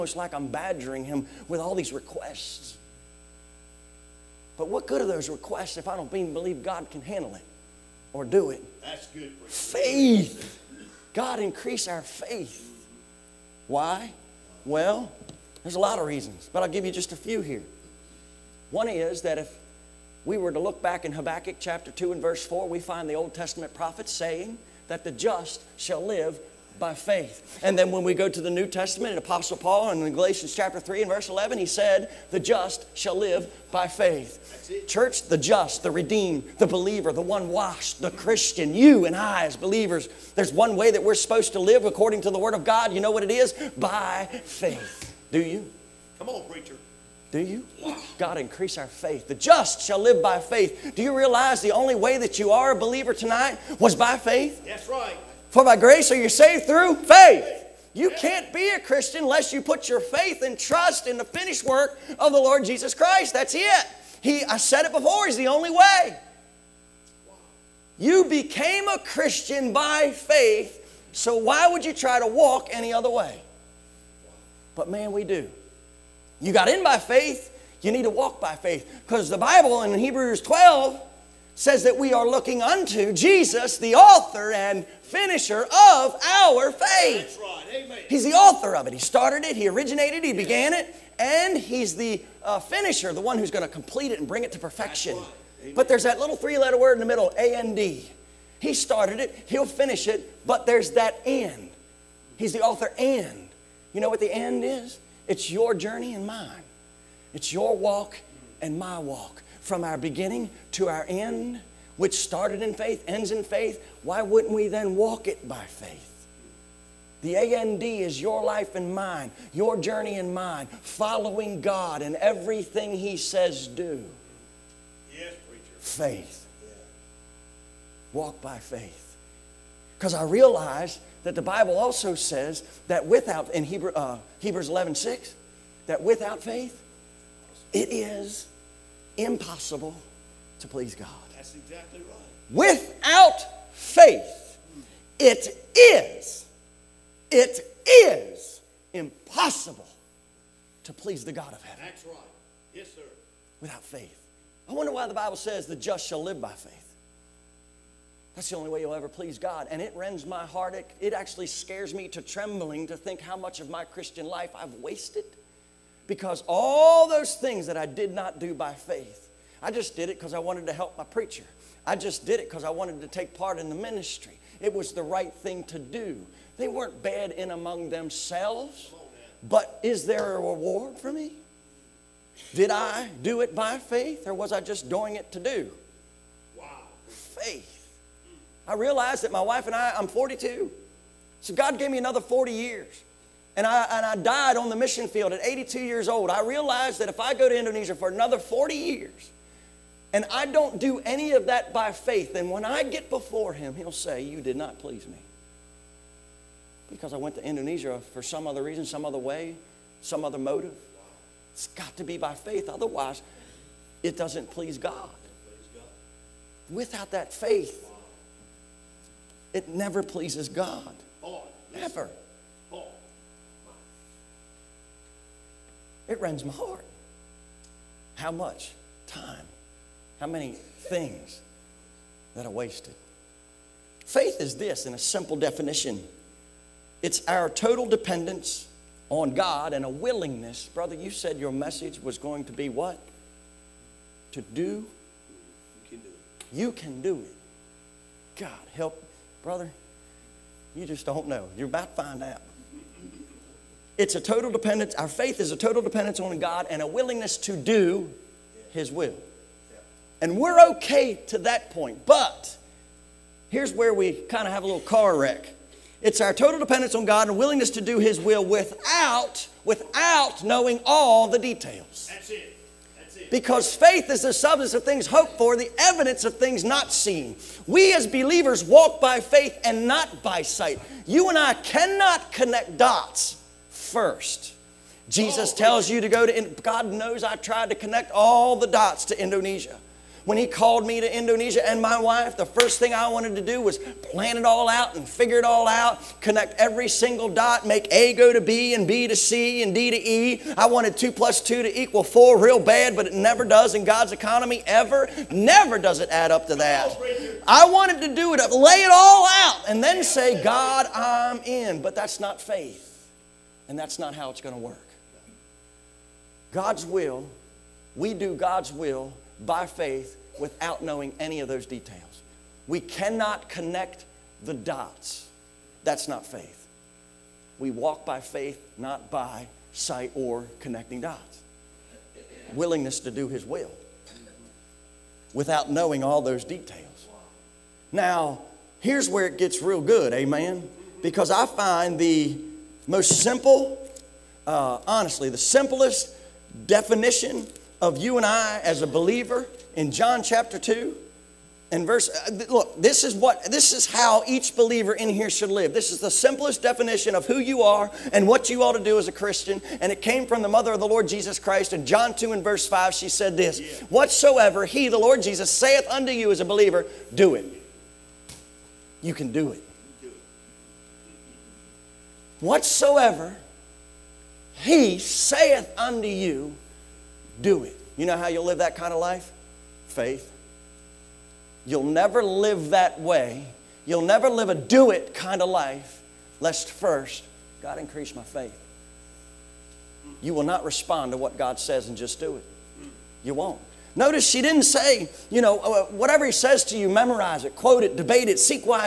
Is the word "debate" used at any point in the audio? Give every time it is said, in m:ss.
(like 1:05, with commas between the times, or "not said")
6:37.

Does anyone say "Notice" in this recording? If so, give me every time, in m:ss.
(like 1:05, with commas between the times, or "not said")
6:33.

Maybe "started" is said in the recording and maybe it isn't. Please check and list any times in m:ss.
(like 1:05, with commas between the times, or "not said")
1:28, 1:38, 1:52.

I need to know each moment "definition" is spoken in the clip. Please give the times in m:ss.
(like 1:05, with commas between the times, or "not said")
3:55, 5:46, 5:56.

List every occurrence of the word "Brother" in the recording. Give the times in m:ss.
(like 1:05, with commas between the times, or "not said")
4:00, 4:09.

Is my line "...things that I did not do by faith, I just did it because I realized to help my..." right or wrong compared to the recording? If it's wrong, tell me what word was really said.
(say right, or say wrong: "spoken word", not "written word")
wrong: "wanted", not "realized".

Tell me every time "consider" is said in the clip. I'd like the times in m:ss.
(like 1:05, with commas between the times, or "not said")
not said.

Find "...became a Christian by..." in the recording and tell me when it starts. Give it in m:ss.
1:08.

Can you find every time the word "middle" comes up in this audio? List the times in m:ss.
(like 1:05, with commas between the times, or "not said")
1:37.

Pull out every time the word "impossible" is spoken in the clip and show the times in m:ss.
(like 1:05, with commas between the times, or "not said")
2:19, 2:28.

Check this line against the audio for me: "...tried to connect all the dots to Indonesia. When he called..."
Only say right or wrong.
right.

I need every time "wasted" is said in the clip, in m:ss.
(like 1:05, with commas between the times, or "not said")
2:44, 3:52.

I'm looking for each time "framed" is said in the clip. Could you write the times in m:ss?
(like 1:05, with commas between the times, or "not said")
not said.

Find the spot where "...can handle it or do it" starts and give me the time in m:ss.
0:06.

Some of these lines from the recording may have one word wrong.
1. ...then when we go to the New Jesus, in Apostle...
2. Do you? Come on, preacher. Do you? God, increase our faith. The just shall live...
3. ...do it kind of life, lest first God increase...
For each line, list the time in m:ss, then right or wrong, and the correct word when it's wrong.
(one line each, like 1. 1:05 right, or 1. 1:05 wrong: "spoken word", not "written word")
1. 0:27 wrong: "Testament", not "Jesus"
2. 0:45 right
3. 6:24 right.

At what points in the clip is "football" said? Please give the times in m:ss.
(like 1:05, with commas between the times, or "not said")
not said.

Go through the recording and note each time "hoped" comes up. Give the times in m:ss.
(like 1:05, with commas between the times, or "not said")
4:35.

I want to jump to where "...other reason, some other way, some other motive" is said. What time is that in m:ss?
3:28.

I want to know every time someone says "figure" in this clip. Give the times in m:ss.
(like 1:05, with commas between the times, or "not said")
4:55.